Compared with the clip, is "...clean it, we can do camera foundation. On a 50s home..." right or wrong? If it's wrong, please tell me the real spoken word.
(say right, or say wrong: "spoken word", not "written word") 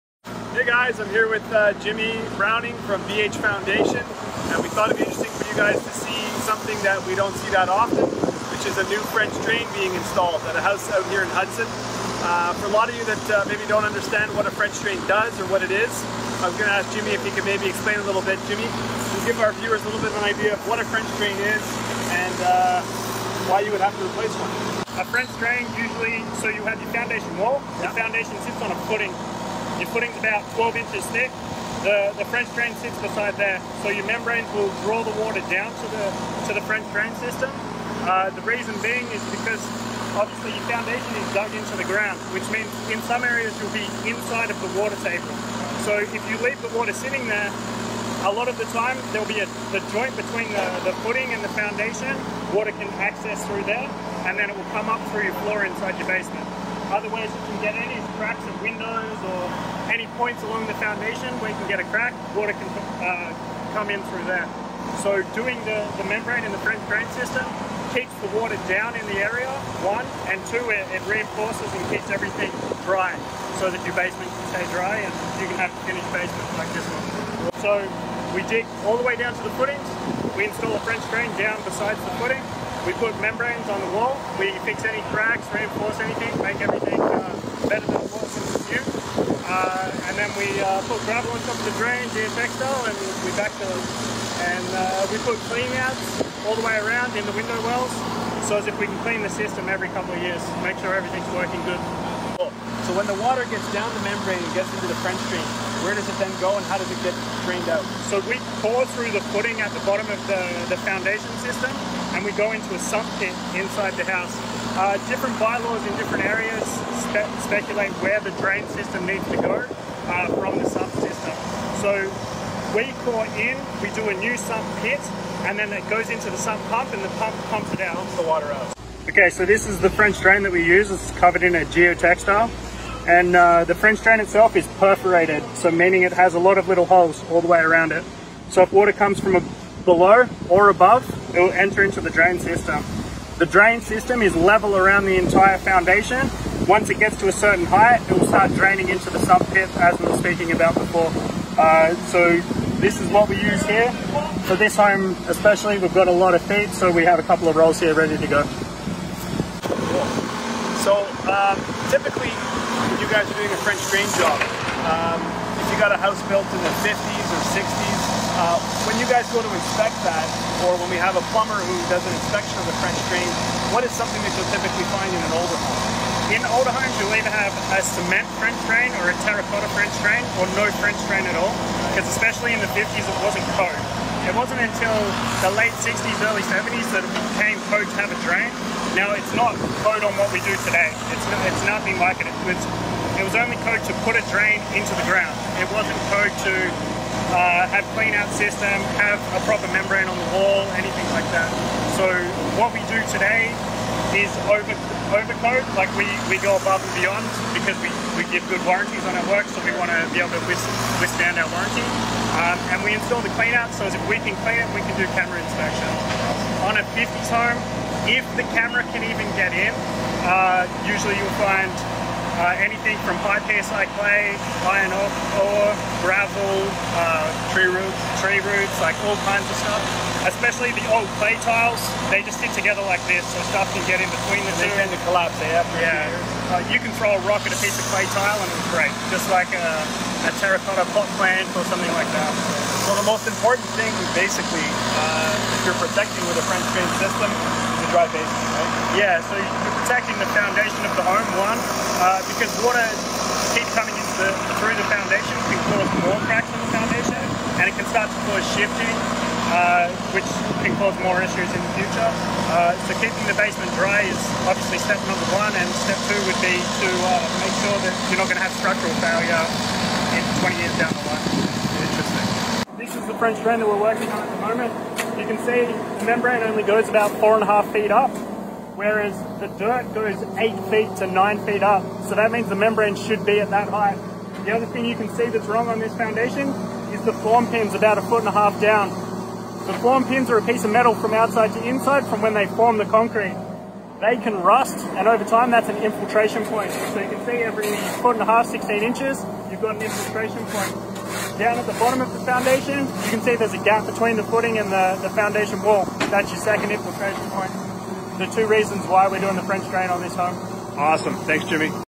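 wrong: "inspection", not "foundation".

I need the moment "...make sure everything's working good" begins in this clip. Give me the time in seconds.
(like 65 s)
100 s.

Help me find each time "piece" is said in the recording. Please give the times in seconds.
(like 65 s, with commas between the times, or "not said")
237 s, 290 s.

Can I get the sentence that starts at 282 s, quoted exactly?
So that means the membrane should be at that height.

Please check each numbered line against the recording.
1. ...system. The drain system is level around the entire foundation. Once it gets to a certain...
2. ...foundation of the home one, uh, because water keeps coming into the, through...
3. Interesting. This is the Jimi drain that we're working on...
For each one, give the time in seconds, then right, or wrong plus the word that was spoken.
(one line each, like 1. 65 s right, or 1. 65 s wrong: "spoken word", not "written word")
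1. 142 s right
2. 250 s right
3. 271 s wrong: "French", not "Jimi".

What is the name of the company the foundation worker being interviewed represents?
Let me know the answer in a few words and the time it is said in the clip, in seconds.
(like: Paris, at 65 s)
BH Foundation, at 3 s.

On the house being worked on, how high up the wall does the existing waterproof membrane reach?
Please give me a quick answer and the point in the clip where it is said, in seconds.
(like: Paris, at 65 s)
4.5 feet, at 277 s.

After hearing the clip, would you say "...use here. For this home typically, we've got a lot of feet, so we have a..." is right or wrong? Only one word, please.
wrong.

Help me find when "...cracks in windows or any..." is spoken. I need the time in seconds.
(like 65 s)
58 s.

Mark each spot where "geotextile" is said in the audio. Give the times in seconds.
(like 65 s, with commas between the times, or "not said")
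92 s, 131 s.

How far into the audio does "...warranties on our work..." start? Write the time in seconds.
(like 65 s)
208 s.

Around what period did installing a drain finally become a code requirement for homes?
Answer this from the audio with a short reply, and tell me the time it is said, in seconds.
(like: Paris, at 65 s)
Late 60s, early 70s, at 185 s.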